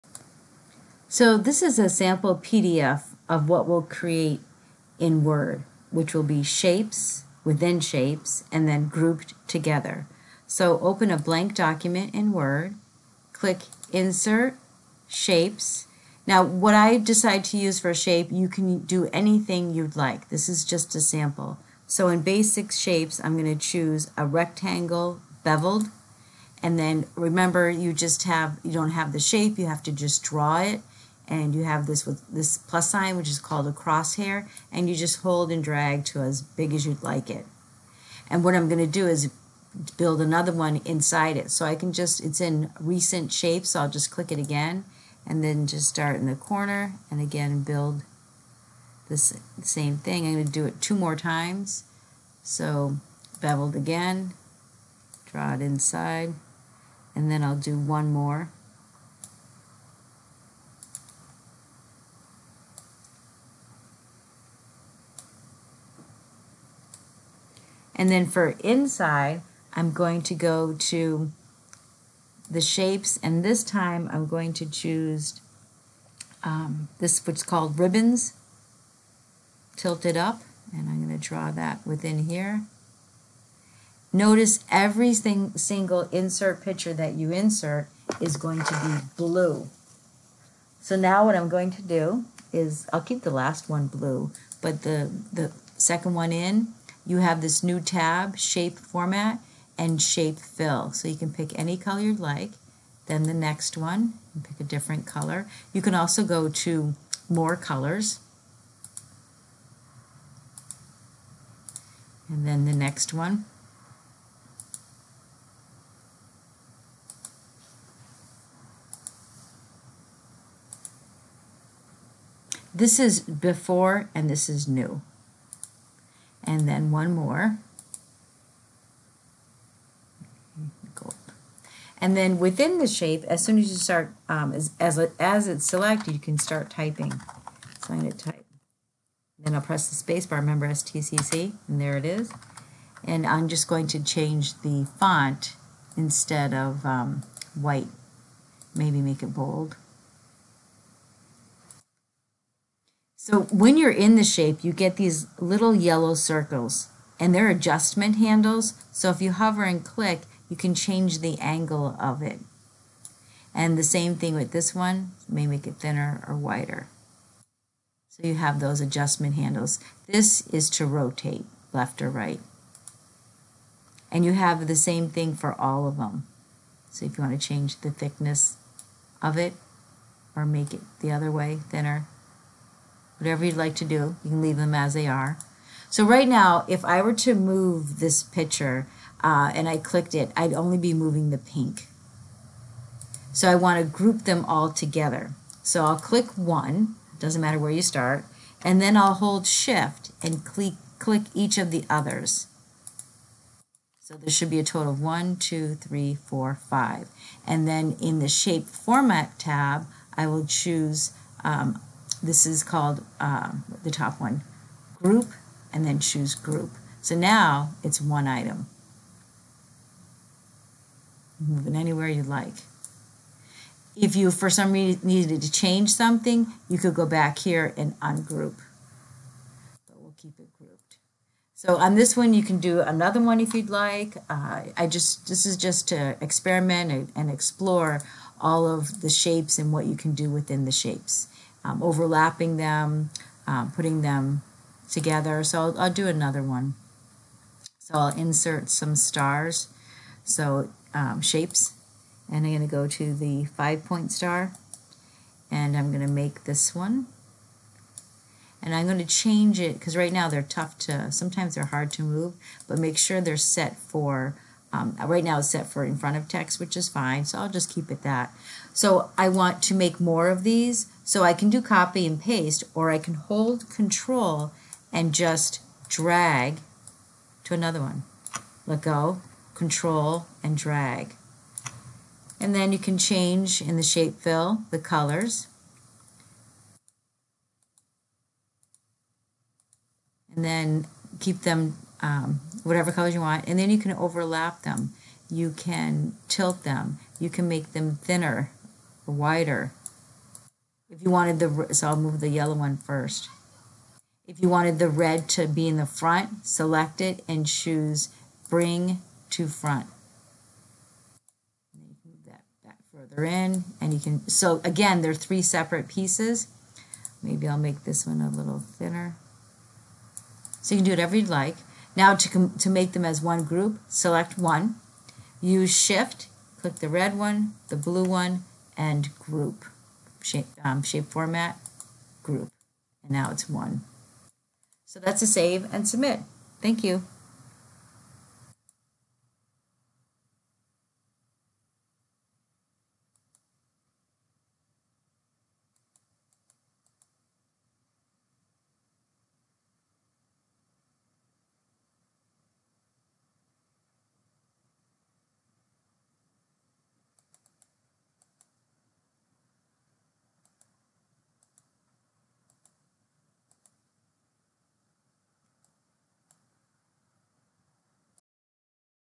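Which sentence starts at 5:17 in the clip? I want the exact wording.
Maybe I'll make this one a little thinner.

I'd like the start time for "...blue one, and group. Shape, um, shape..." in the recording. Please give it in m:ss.
5:27.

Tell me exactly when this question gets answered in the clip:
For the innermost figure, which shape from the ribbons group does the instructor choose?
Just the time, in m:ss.
1:19.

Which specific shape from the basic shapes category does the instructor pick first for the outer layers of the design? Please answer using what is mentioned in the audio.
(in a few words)
Rectangle beveled.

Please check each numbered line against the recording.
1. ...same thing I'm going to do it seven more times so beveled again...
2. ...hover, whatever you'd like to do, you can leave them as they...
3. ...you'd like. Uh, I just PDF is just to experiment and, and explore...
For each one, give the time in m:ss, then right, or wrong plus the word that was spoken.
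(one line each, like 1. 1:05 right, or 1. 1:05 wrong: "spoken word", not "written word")
1. 0:49 wrong: "two", not "seven"
2. 3:01 wrong: "thinner", not "hover"
3. 3:53 wrong: "This", not "PDF".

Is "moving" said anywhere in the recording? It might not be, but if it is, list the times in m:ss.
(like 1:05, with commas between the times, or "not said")
3:10, 3:41.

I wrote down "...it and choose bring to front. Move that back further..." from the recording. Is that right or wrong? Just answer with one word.
right.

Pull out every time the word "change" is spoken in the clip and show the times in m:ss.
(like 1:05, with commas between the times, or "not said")
2:24, 2:40, 2:57, 3:45, 4:19, 4:42.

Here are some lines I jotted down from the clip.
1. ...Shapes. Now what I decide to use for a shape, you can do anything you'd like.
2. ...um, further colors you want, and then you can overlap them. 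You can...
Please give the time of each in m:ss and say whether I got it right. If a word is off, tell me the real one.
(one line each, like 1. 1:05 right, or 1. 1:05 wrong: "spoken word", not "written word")
1. 0:15 right
2. 4:52 wrong: "whatever", not "further".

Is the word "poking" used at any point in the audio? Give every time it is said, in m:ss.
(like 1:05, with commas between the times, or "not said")
not said.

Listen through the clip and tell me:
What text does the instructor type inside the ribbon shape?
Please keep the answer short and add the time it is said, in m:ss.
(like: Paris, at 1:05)
STCC, at 2:20.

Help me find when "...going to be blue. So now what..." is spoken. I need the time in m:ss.
1:28.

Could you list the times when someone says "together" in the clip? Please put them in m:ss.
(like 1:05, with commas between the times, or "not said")
0:09, 3:14, 4:04.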